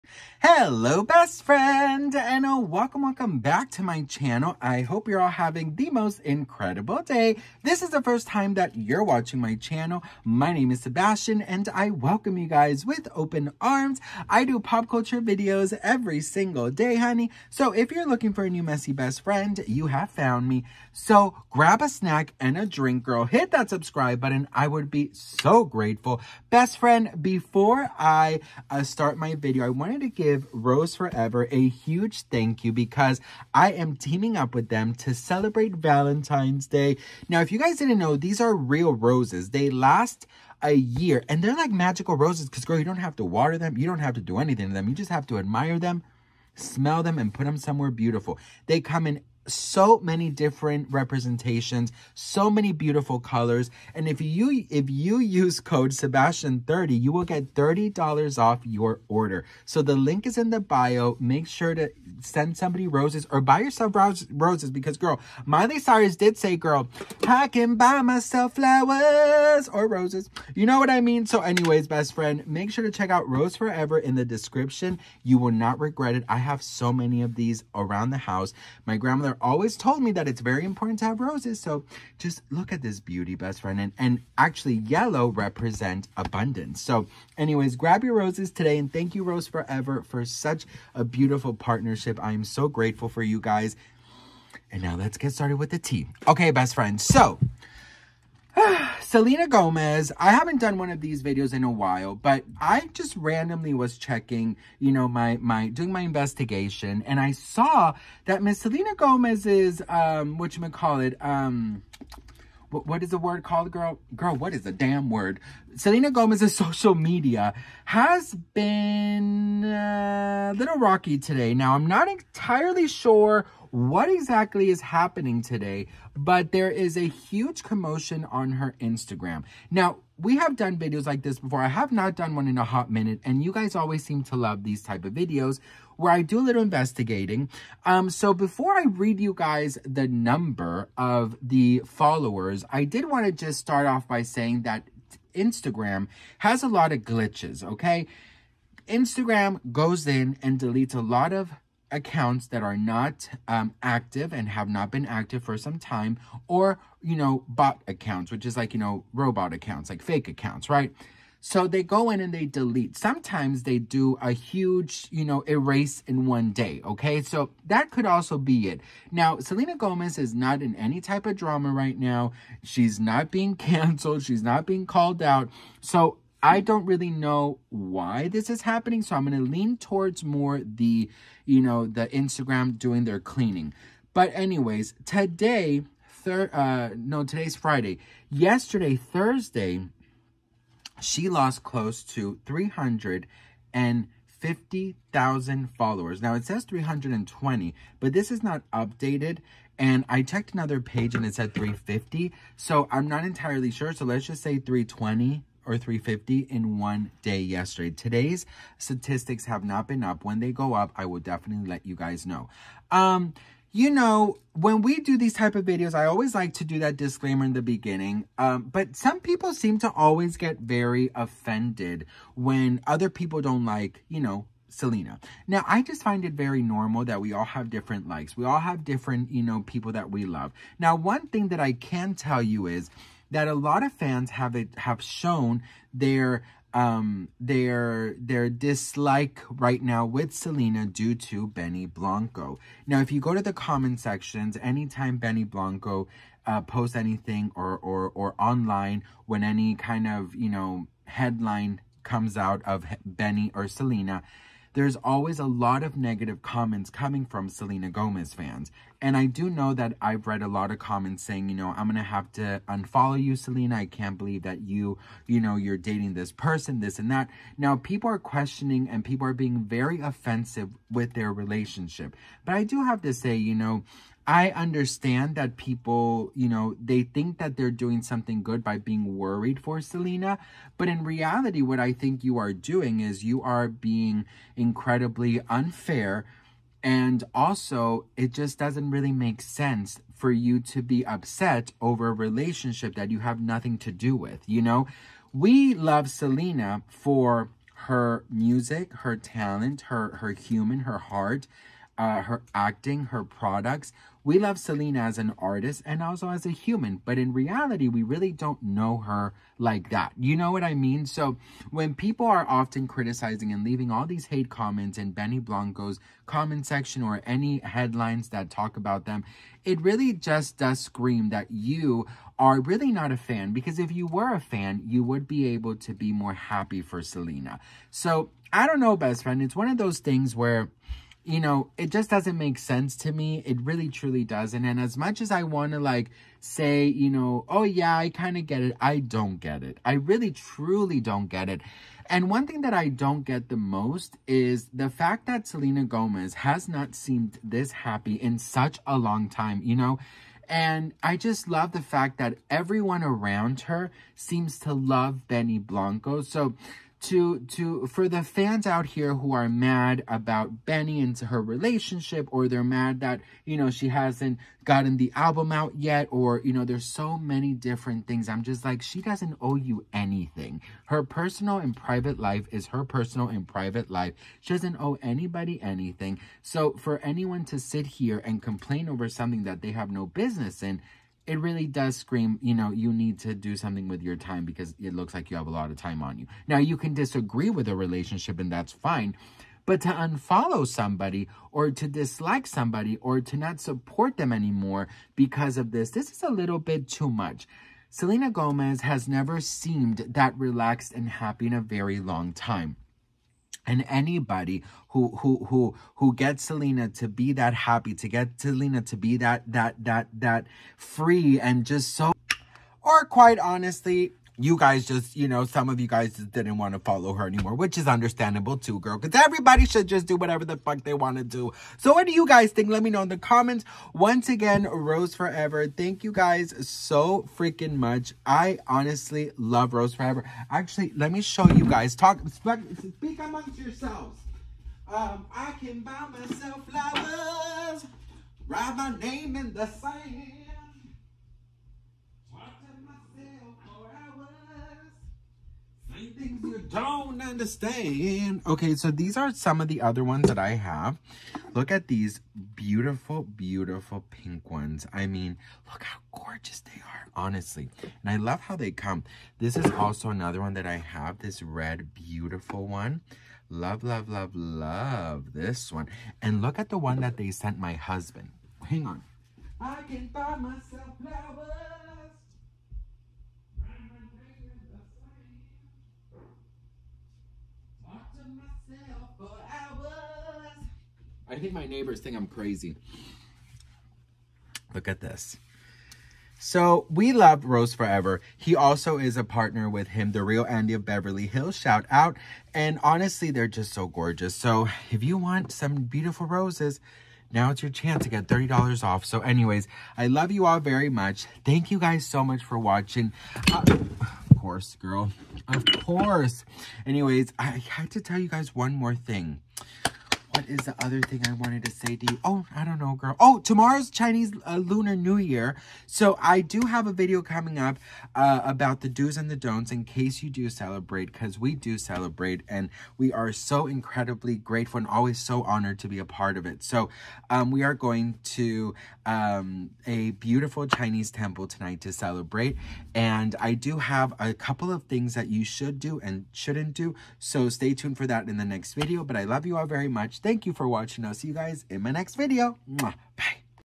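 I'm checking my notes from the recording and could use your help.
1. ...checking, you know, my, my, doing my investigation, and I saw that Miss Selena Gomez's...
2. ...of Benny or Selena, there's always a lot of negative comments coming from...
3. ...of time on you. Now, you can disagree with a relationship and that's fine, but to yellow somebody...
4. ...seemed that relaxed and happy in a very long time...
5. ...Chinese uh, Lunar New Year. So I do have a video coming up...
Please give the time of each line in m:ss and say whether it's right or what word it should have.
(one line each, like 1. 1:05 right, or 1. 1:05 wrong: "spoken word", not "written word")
1. 1:43 right
2. 4:12 right
3. 6:25 wrong: "unfollow", not "yellow"
4. 6:39 right
5. 8:33 right.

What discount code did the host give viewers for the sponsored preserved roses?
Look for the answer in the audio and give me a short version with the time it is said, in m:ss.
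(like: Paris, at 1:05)
Sebastian30, at 0:55.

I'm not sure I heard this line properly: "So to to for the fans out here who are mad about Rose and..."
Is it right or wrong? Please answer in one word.
wrong.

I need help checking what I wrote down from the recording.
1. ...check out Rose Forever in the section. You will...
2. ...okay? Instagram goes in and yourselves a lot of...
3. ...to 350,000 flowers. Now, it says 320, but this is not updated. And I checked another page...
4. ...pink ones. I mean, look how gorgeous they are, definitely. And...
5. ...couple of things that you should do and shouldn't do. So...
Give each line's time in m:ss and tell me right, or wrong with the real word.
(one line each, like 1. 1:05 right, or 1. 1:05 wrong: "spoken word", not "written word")
1. 1:12 wrong: "description", not "section"
2. 2:27 wrong: "deletes", not "yourselves"
3. 3:12 wrong: "followers", not "flowers"
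4. 7:34 wrong: "honestly", not "definitely"
5. 8:54 right.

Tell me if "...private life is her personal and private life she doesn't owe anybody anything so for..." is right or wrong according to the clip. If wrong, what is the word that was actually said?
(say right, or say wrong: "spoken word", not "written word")
right.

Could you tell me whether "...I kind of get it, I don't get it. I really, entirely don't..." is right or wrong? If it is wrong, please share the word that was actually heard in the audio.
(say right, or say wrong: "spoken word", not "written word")
wrong: "truly", not "entirely".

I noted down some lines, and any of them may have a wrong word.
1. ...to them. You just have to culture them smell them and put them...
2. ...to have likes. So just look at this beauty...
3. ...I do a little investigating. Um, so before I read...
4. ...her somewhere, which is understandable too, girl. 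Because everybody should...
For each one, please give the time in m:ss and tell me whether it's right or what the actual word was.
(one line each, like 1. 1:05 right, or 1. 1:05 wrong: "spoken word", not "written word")
1. 0:44 wrong: "admire", not "culture"
2. 1:20 wrong: "roses", not "likes"
3. 2:16 right
4. 6:57 wrong: "anymore", not "somewhere".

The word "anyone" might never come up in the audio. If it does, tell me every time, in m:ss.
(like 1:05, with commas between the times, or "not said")
6:16.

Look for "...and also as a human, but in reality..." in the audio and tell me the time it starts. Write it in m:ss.
5:05.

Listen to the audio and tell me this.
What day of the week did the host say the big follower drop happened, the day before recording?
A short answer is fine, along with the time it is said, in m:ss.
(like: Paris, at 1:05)
Thursday, at 3:08.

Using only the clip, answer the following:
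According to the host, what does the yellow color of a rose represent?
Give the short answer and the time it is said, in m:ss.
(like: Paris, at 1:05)
Abundance, at 1:26.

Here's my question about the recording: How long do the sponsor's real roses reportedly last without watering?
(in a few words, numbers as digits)
A year.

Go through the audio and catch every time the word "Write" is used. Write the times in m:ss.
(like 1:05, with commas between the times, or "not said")
7:18.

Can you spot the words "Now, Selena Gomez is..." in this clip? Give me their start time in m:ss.
2:49.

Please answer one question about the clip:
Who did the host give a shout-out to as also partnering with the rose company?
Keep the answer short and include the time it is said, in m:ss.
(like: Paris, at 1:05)
Andy of Beverly Hills, at 8:10.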